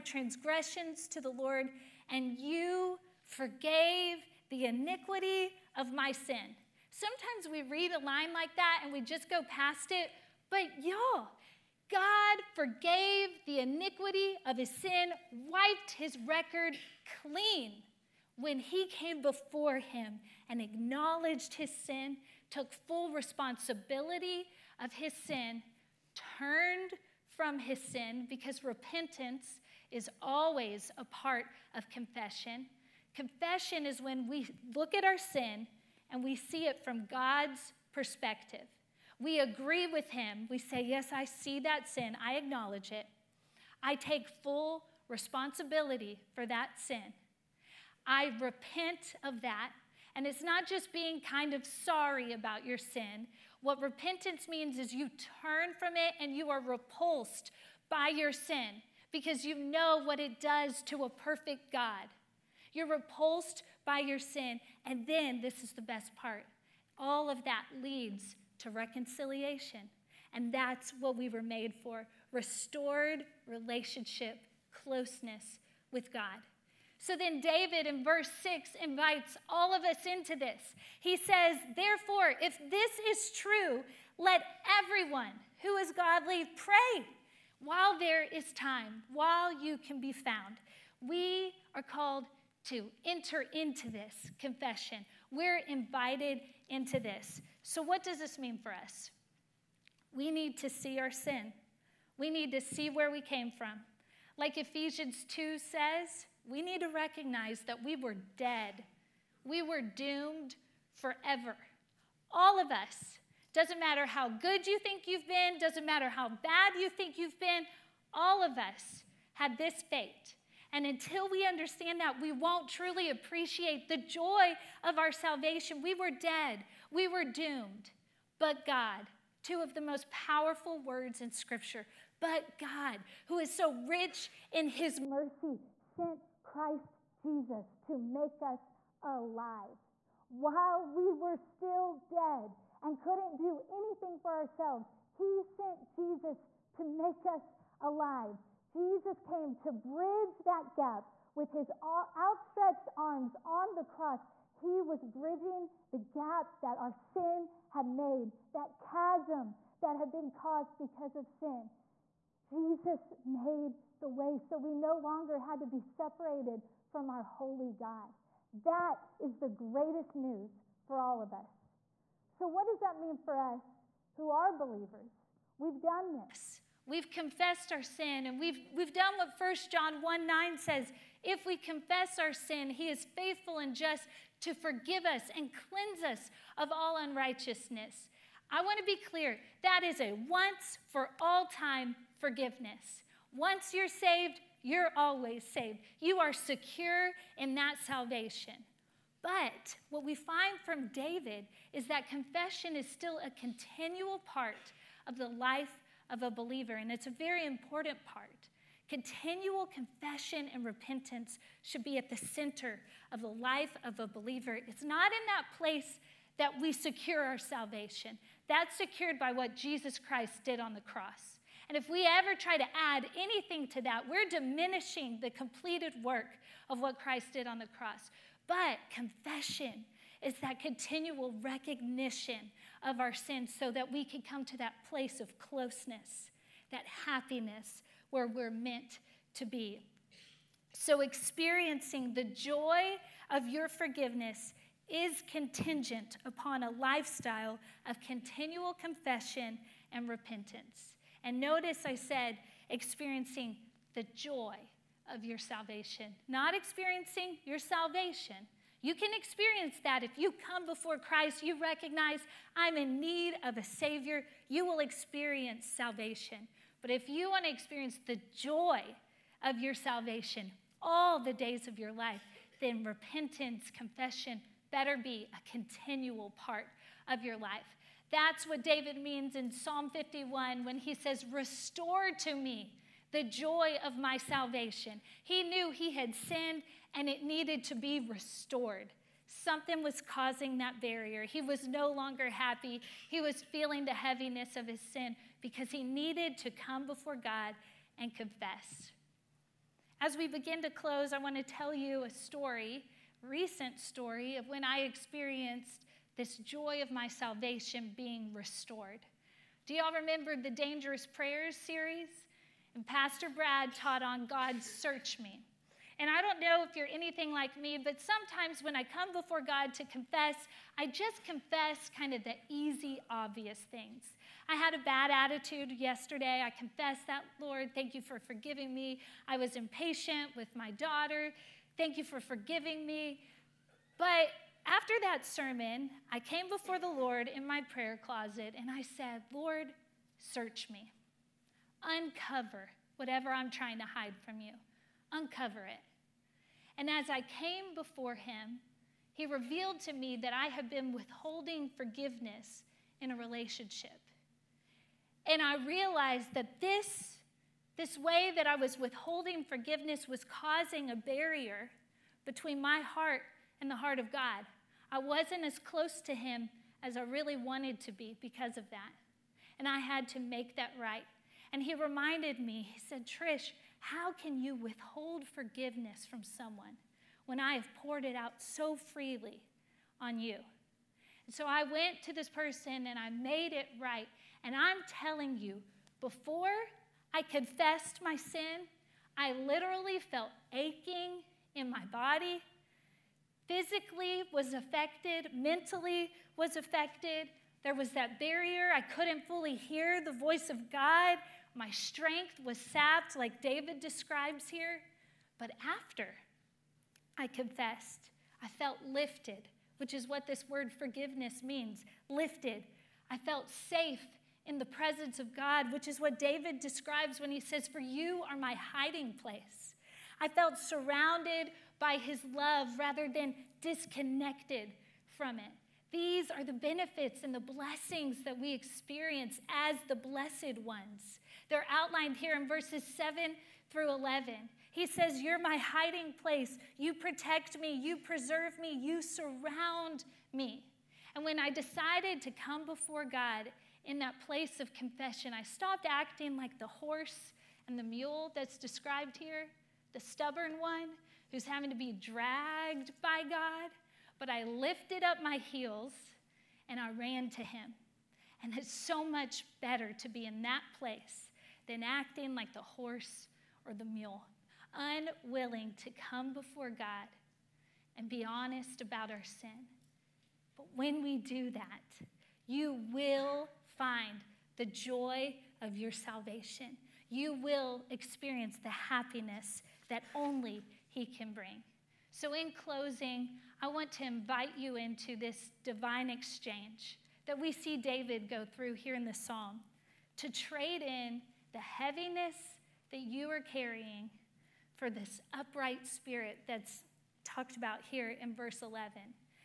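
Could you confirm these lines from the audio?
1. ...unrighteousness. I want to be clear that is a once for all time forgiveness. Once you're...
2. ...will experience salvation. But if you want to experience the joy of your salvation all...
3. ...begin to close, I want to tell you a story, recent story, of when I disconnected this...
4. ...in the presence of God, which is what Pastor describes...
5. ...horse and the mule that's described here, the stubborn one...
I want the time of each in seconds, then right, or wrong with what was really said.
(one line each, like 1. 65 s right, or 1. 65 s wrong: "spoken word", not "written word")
1. 186 s right
2. 264 s right
3. 300 s wrong: "experienced", not "disconnected"
4. 414 s wrong: "David", not "Pastor"
5. 446 s right.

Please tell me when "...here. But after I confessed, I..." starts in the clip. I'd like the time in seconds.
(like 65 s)
404 s.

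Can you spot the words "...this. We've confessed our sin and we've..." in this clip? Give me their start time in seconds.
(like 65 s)
176 s.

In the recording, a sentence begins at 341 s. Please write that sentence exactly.
Uncover whatever I'm trying to hide from you.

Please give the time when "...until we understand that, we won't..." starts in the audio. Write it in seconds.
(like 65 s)
120 s.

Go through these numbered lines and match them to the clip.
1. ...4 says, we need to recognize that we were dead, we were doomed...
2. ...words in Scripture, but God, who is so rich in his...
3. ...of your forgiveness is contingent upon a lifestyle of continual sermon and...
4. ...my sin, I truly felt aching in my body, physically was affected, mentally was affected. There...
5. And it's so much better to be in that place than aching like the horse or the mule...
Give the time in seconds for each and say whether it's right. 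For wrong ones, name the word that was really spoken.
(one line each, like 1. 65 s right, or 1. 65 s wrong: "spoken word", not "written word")
1. 105 s wrong: "2", not "4"
2. 130 s right
3. 243 s wrong: "confession", not "sermon"
4. 388 s wrong: "literally", not "truly"
5. 458 s wrong: "acting", not "aching".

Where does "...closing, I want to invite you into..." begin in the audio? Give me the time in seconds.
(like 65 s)
482 s.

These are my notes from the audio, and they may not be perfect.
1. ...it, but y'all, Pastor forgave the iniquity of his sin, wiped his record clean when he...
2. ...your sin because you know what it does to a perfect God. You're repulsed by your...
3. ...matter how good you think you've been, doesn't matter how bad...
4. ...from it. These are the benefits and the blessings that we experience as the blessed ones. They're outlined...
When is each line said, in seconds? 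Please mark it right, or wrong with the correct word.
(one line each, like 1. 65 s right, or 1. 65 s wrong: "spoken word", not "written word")
1. 9 s wrong: "God", not "Pastor"
2. 58 s right
3. 113 s right
4. 425 s right.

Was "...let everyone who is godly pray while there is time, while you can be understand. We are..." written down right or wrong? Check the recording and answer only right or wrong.
wrong.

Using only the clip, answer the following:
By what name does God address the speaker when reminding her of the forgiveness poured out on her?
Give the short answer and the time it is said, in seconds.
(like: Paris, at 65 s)
Trish, at 373 s.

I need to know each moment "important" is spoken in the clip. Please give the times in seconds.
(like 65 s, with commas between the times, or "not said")
207 s.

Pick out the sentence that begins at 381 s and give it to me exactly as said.
And so I went to this person and I made it right.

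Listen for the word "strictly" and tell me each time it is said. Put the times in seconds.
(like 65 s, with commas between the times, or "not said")
not said.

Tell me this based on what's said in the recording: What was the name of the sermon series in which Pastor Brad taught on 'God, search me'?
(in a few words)
Dangerous Prayers.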